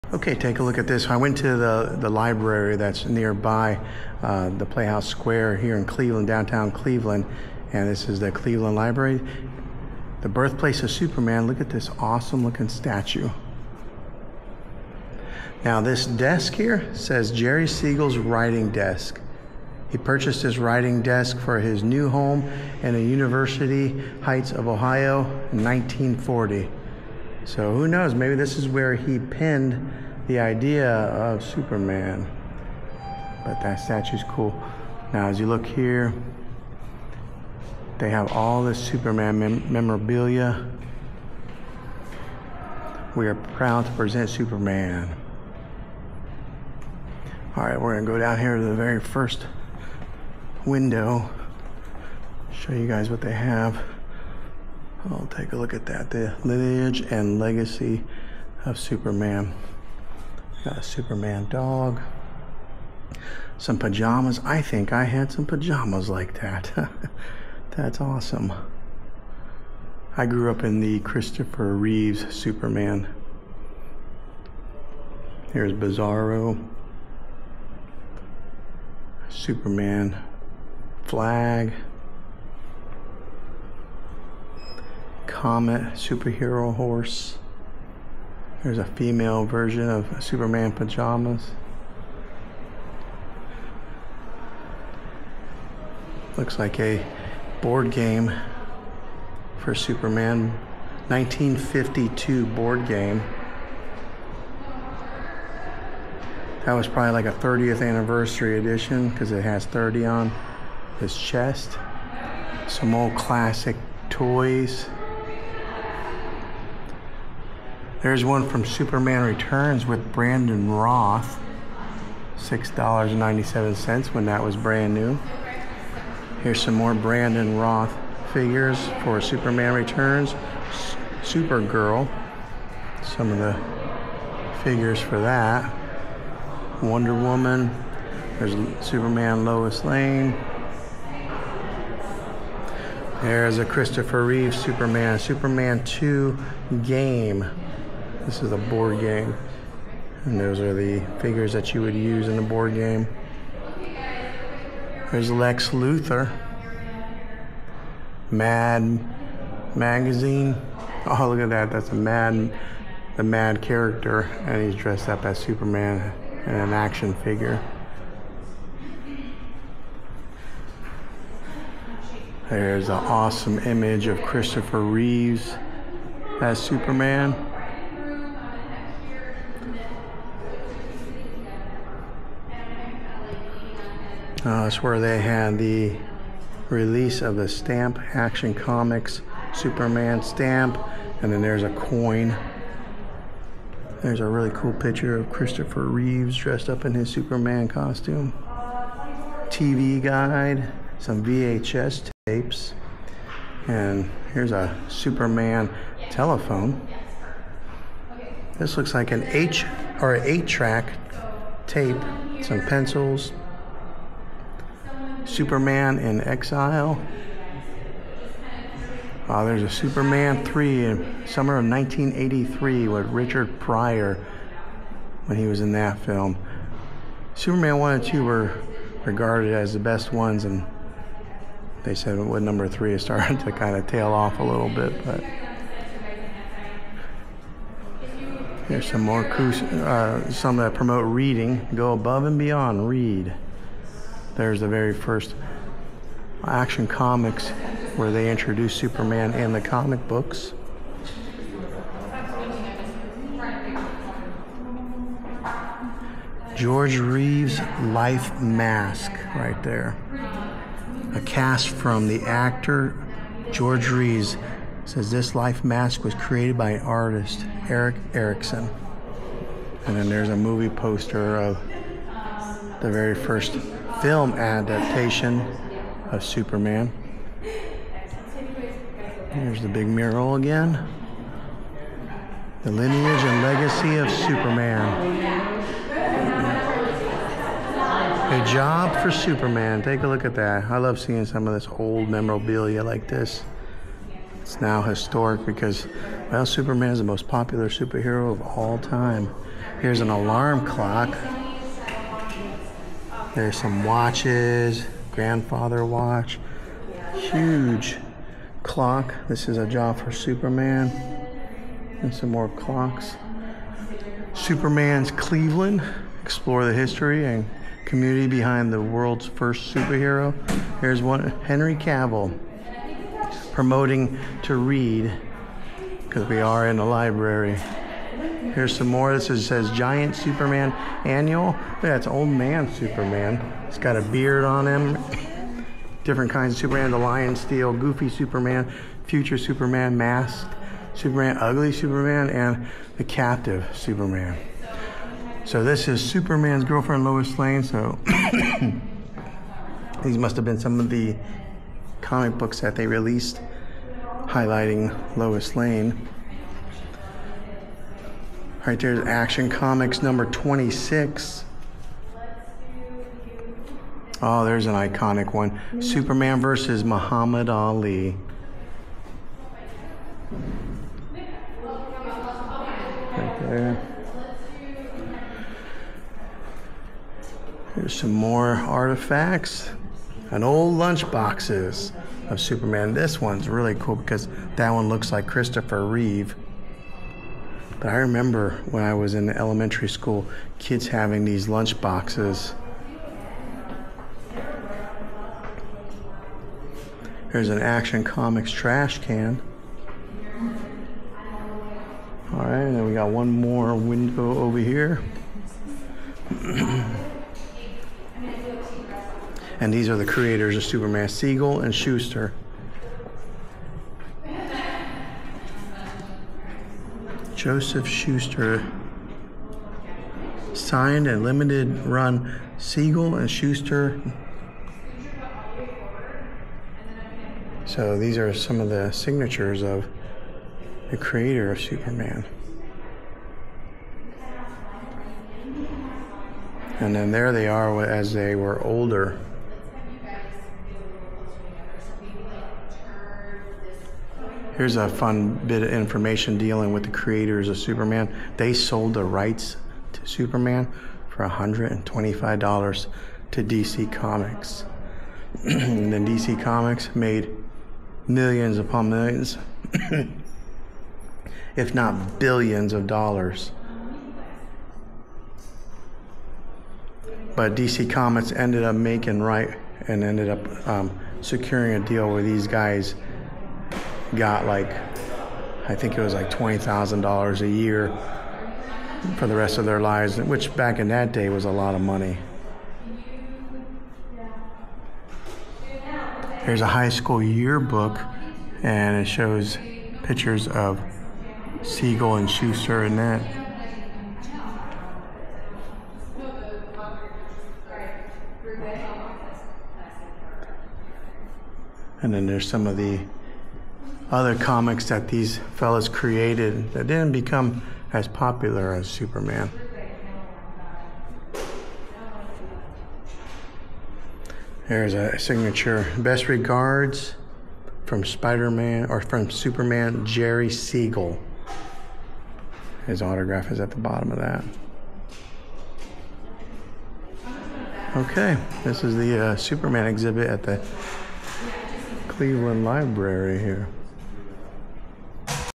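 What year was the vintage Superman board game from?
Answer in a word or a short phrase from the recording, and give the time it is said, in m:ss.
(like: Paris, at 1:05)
1952, at 1:41.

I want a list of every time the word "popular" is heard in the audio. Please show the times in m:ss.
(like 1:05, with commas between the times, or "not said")
4:57, 8:28.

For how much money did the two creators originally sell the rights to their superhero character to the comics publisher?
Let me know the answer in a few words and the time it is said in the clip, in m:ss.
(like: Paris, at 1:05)
$125, at 7:31.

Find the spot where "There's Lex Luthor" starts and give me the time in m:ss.
2:35.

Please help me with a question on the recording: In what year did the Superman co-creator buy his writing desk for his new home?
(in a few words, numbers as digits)
1940.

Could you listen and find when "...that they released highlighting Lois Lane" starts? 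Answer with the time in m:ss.
5:52.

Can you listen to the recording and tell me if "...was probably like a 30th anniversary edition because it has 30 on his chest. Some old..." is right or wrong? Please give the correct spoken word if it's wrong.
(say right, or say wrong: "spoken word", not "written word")
right.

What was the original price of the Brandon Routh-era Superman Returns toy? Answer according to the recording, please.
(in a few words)
$6.97.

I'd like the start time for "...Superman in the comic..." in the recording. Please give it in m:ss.
4:08.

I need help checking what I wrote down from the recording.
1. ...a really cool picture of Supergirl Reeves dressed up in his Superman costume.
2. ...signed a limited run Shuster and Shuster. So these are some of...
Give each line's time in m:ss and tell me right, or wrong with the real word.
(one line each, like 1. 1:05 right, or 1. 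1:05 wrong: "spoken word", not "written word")
1. 3:14 wrong: "Christopher", not "Supergirl"
2. 7:00 wrong: "Siegel", not "Shuster".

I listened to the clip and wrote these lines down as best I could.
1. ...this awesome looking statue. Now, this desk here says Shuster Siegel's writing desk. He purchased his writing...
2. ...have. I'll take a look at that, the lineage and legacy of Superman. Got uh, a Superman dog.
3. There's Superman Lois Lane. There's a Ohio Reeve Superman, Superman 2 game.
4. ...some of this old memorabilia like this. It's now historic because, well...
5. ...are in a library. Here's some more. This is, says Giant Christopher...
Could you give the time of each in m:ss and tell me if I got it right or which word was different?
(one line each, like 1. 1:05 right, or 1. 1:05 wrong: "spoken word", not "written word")
1. 0:11 wrong: "Jerry", not "Shuster"
2. 0:53 right
3. 2:18 wrong: "Christopher", not "Ohio"
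4. 4:51 right
5. 5:26 wrong: "Superman", not "Christopher".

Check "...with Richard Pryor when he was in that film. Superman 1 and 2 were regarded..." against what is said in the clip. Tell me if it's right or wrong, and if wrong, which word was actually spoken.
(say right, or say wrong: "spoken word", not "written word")
right.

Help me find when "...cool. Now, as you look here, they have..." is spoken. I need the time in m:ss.
0:34.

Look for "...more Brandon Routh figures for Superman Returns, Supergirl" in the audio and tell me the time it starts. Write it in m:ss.
2:06.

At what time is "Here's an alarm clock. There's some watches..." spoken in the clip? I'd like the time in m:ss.
4:59.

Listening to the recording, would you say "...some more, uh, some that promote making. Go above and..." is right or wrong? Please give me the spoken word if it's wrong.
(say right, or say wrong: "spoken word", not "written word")
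wrong: "reading", not "making".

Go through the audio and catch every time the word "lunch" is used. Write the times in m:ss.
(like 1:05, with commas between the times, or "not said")
6:20, 6:31.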